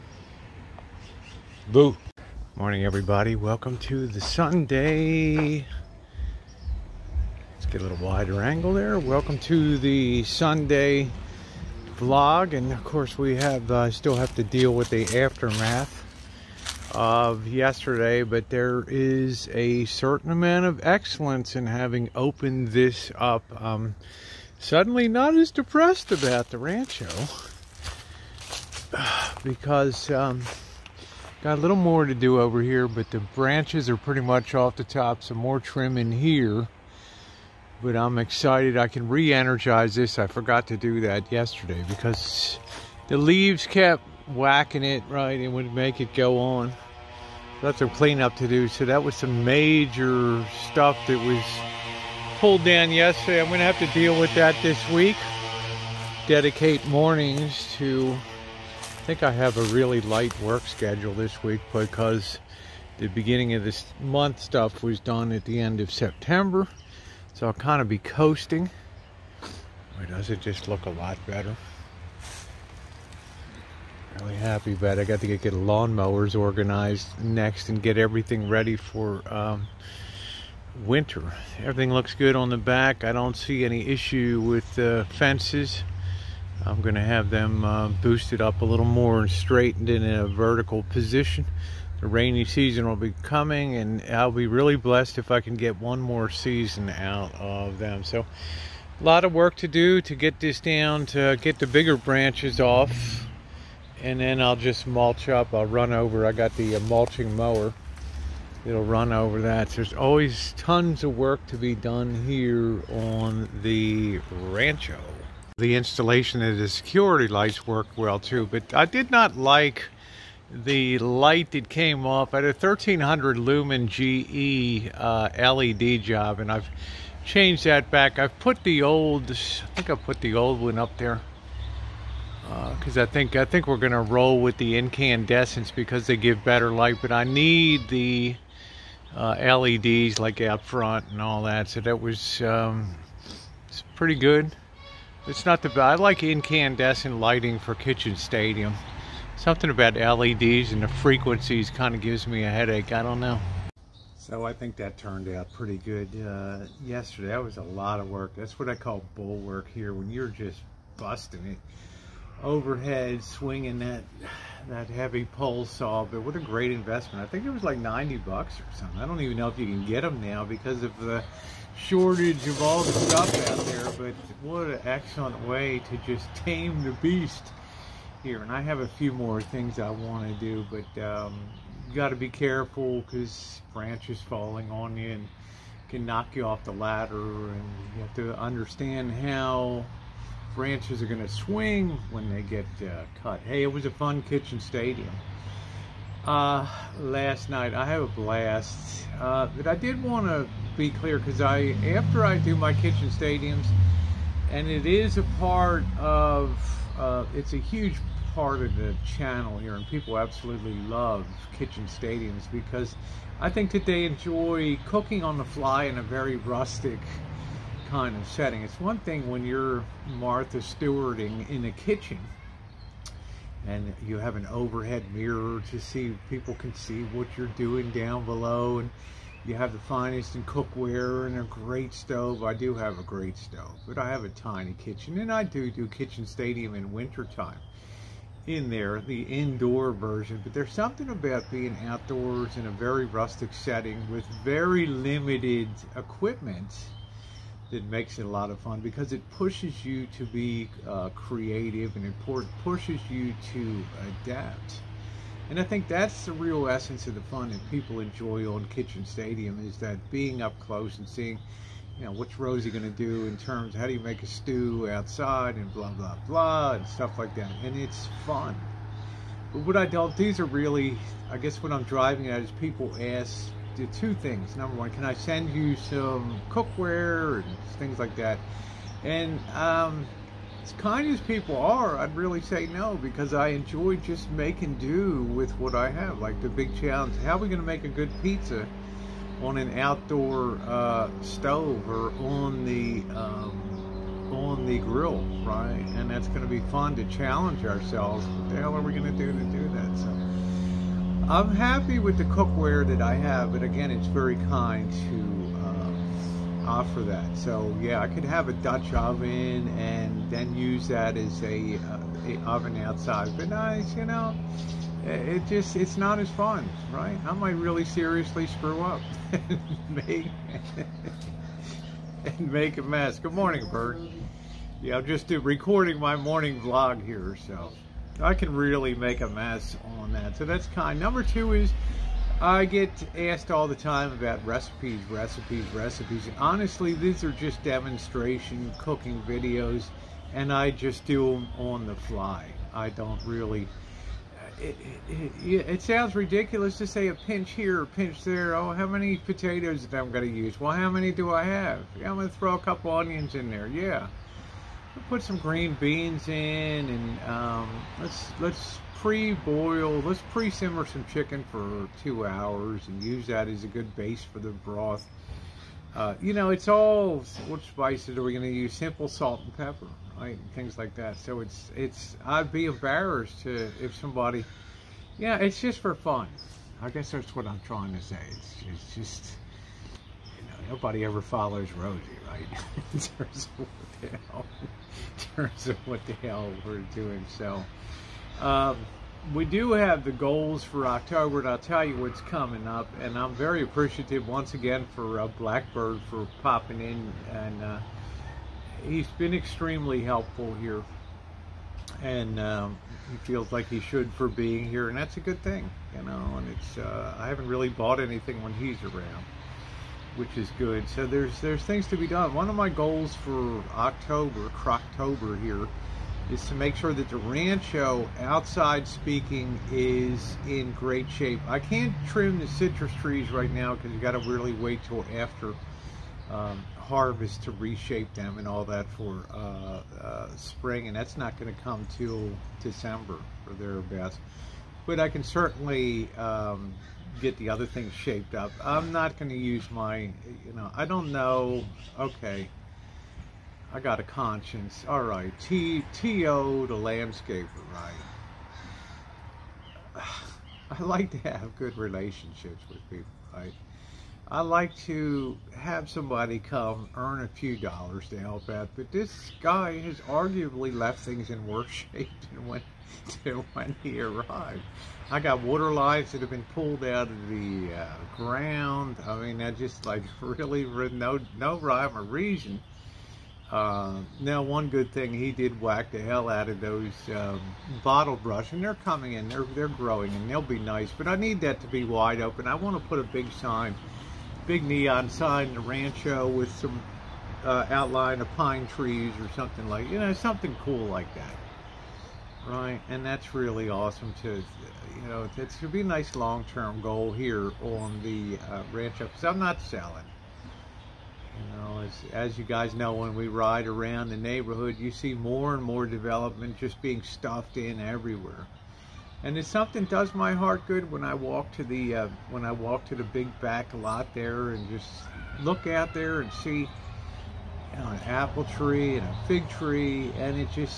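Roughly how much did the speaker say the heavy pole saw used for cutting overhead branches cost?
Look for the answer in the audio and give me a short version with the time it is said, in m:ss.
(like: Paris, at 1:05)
90 bucks, at 2:47.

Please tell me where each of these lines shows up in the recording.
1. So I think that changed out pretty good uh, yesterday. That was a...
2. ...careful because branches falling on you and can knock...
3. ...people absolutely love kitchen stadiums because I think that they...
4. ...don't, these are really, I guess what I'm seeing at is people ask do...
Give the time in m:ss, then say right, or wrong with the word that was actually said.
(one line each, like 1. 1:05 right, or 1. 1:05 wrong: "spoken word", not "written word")
1. 2:34 wrong: "turned", not "changed"
2. 3:02 right
3. 3:29 right
4. 4:29 wrong: "driving", not "seeing".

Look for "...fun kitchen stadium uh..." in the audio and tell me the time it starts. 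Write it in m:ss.
3:13.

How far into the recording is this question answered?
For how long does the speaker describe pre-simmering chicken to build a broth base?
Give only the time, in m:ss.
6:02.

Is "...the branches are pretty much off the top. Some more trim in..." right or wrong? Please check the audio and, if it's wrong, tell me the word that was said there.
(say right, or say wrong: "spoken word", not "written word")
right.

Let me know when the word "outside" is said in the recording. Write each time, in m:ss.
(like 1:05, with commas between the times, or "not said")
4:24, 5:12, 6:58.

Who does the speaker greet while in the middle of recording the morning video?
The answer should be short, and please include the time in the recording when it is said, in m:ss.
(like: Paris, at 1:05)
Bert, at 5:23.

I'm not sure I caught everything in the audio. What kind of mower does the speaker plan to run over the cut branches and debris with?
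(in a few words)
mulching mower.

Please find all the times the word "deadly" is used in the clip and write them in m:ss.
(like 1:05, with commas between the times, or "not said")
not said.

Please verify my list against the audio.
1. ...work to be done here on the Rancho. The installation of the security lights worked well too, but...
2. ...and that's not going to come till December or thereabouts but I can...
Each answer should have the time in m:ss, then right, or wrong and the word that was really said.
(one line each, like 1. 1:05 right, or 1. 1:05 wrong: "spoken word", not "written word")
1. 1:51 right
2. 7:10 right.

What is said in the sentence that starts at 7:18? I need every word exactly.
I'm not going to use my, you know, I don't know.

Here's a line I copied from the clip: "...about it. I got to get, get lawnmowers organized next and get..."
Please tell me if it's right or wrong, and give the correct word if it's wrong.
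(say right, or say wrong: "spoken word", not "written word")
right.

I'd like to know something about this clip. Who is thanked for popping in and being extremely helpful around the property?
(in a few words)
Blackbird.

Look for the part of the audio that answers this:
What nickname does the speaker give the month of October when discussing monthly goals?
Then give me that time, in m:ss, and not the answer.
6:54.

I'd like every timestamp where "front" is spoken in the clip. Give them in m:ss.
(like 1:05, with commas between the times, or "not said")
2:20.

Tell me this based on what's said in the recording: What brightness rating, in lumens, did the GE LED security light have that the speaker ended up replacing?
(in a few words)
1300.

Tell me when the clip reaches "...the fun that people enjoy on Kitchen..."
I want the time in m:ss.
4:17.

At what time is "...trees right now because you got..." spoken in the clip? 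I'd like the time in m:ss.
7:03.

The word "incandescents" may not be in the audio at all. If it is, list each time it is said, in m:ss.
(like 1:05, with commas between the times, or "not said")
2:14, 2:26.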